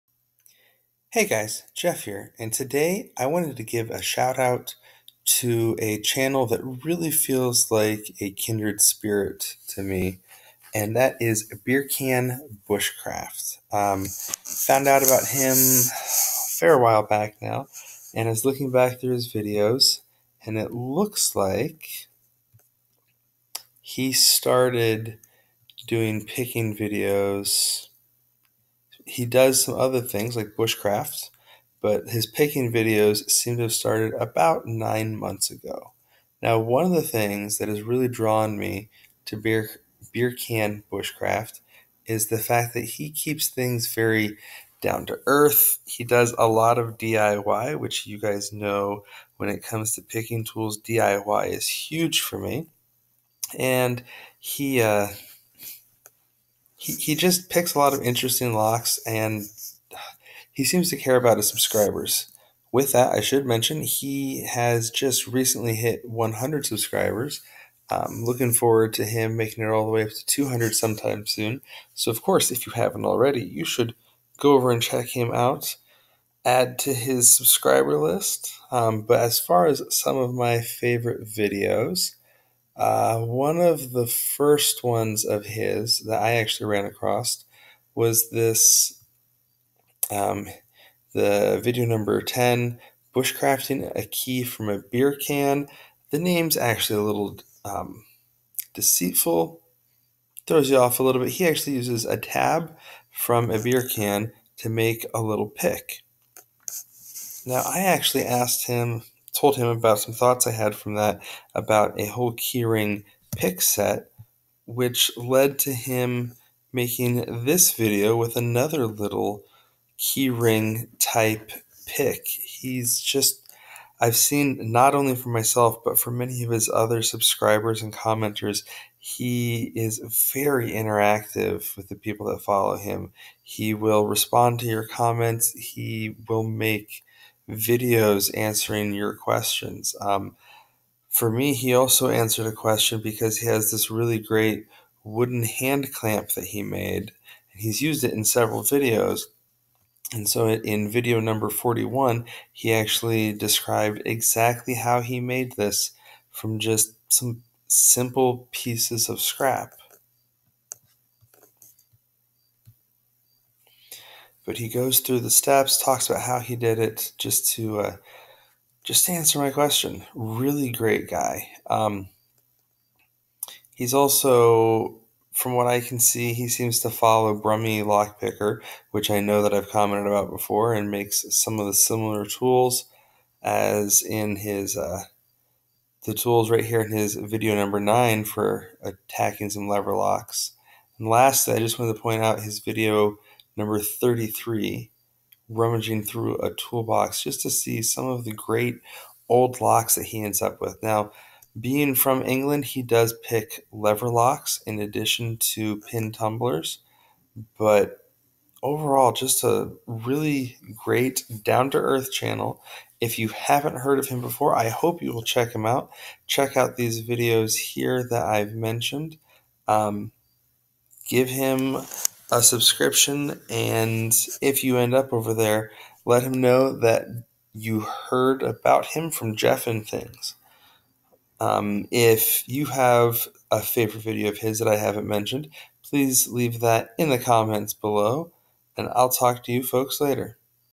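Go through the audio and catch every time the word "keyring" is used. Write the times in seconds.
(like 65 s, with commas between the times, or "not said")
112 s, 119 s.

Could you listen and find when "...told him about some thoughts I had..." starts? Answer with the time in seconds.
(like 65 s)
109 s.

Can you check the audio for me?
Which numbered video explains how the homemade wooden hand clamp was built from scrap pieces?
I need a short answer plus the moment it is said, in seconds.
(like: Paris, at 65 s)
41, at 150 s.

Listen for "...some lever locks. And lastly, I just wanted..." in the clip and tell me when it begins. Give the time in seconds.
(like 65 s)
189 s.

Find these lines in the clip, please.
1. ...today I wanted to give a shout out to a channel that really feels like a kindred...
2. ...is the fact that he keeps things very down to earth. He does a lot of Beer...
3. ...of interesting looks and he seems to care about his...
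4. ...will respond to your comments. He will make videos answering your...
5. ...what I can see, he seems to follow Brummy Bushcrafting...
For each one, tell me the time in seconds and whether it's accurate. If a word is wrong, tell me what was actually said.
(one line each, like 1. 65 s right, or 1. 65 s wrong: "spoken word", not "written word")
1. 2 s right
2. 42 s wrong: "DIY", not "Beer"
3. 57 s wrong: "locks", not "looks"
4. 133 s right
5. 175 s wrong: "Lockpicker", not "Bushcrafting".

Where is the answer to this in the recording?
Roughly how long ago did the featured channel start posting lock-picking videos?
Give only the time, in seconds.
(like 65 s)
34 s.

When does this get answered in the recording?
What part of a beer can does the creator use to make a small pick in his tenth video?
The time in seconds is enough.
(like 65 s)
102 s.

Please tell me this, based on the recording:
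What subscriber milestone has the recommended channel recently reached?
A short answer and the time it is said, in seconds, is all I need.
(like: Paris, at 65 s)
100, at 66 s.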